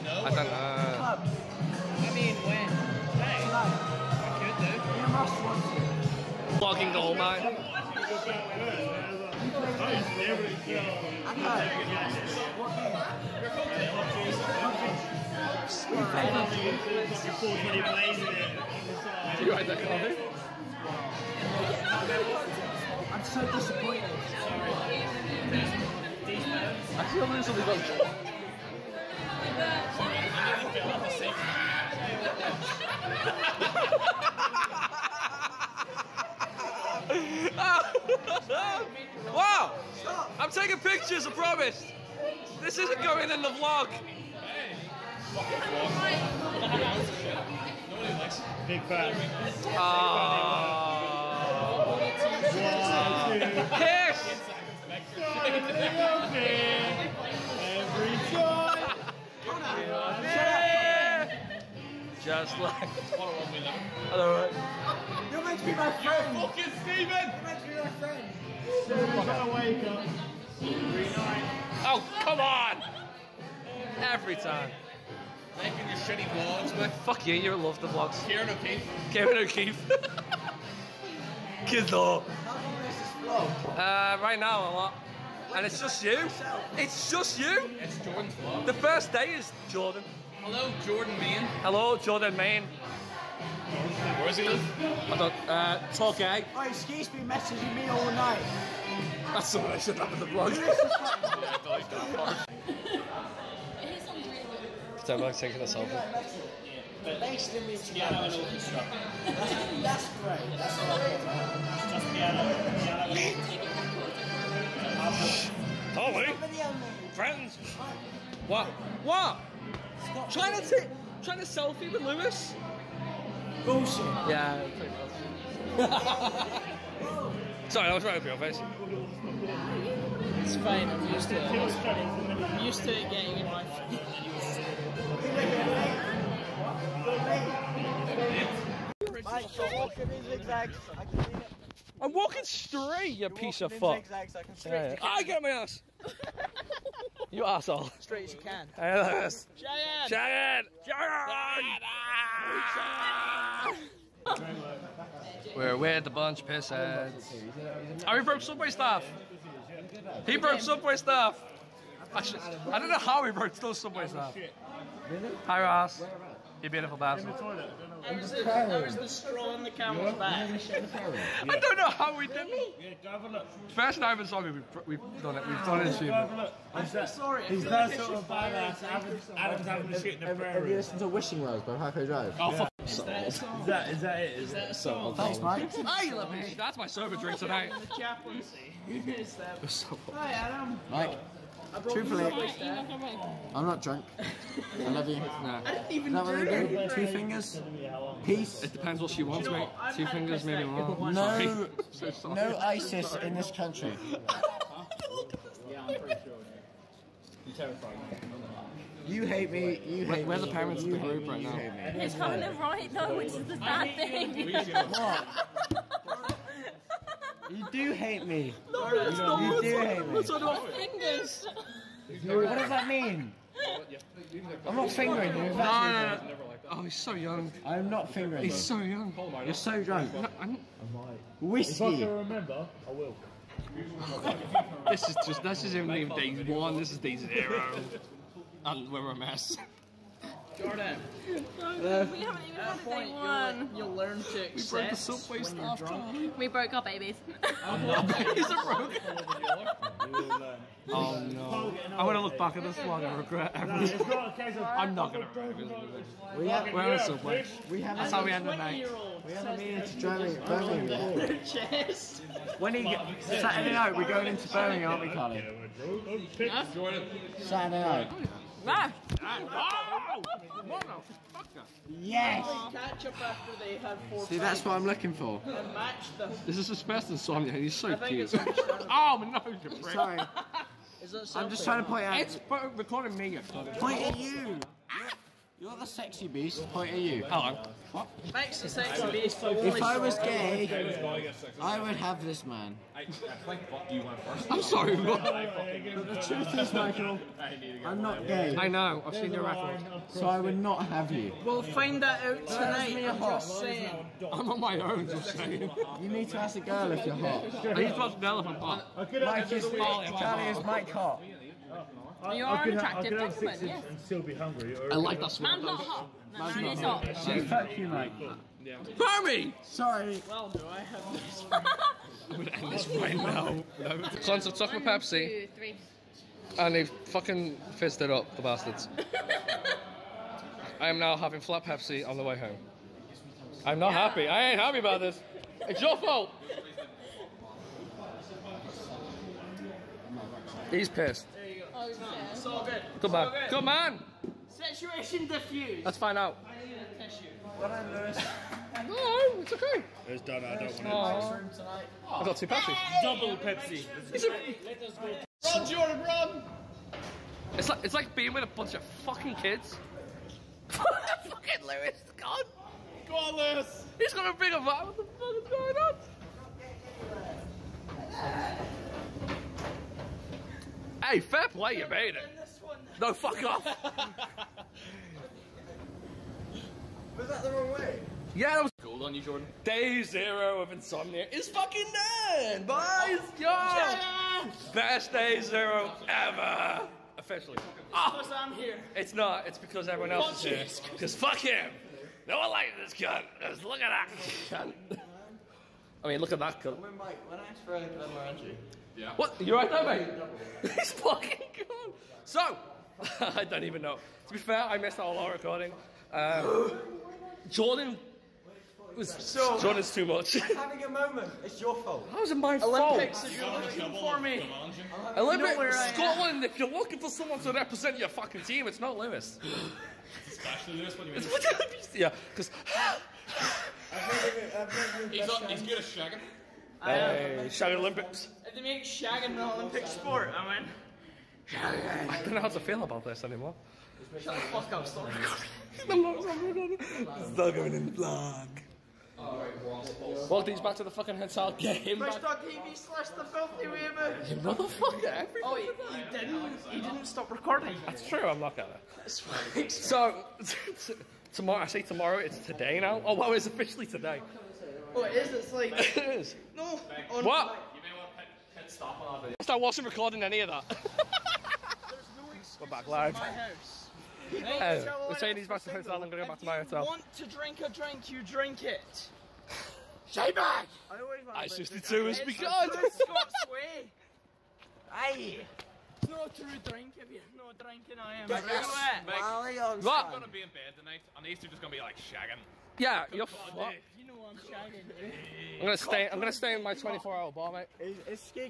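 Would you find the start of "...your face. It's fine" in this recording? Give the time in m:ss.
2:08.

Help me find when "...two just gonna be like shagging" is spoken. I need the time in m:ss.
8:01.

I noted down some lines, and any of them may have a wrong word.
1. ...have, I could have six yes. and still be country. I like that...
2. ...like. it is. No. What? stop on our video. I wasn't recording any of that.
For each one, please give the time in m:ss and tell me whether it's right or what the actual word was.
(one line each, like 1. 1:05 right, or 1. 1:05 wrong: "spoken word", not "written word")
1. 5:13 wrong: "hungry", not "country"
2. 7:35 right.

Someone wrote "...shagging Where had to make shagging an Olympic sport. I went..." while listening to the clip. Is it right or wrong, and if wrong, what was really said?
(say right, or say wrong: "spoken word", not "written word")
wrong: "Olympics", not "Where".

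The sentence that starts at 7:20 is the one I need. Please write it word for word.
Well, these back to the fucking hotel.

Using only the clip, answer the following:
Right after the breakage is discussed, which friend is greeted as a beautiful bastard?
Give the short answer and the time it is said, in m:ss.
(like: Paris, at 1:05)
Ross, at 2:45.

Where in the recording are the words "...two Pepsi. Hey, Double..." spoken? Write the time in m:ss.
5:52.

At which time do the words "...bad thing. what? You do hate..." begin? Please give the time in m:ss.
3:33.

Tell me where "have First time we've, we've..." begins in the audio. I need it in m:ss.
2:53.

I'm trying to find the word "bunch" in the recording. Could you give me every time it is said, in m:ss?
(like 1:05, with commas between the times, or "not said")
2:36, 5:58.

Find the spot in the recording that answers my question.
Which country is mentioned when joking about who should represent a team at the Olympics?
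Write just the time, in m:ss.
6:55.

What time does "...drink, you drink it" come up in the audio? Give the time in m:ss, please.
7:47.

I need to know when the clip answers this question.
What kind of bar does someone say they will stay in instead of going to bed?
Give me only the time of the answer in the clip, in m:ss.
8:06.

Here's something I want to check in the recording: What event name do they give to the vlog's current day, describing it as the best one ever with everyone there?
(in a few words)
Insomnia.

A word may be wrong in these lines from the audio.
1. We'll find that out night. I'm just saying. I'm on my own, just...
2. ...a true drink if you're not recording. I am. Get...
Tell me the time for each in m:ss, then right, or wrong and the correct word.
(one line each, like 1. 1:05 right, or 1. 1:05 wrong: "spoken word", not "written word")
1. 5:01 wrong: "tonight", not "night"
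2. 7:56 wrong: "drinking", not "recording".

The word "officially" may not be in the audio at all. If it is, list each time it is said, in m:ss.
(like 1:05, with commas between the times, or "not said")
6:27, 7:33.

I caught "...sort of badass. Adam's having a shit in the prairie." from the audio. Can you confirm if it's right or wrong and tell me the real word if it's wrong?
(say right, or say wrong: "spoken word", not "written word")
right.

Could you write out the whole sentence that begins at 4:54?
I'm sorry, But the truth is, Michael, I'm not gay.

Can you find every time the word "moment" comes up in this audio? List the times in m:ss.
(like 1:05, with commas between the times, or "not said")
6:50.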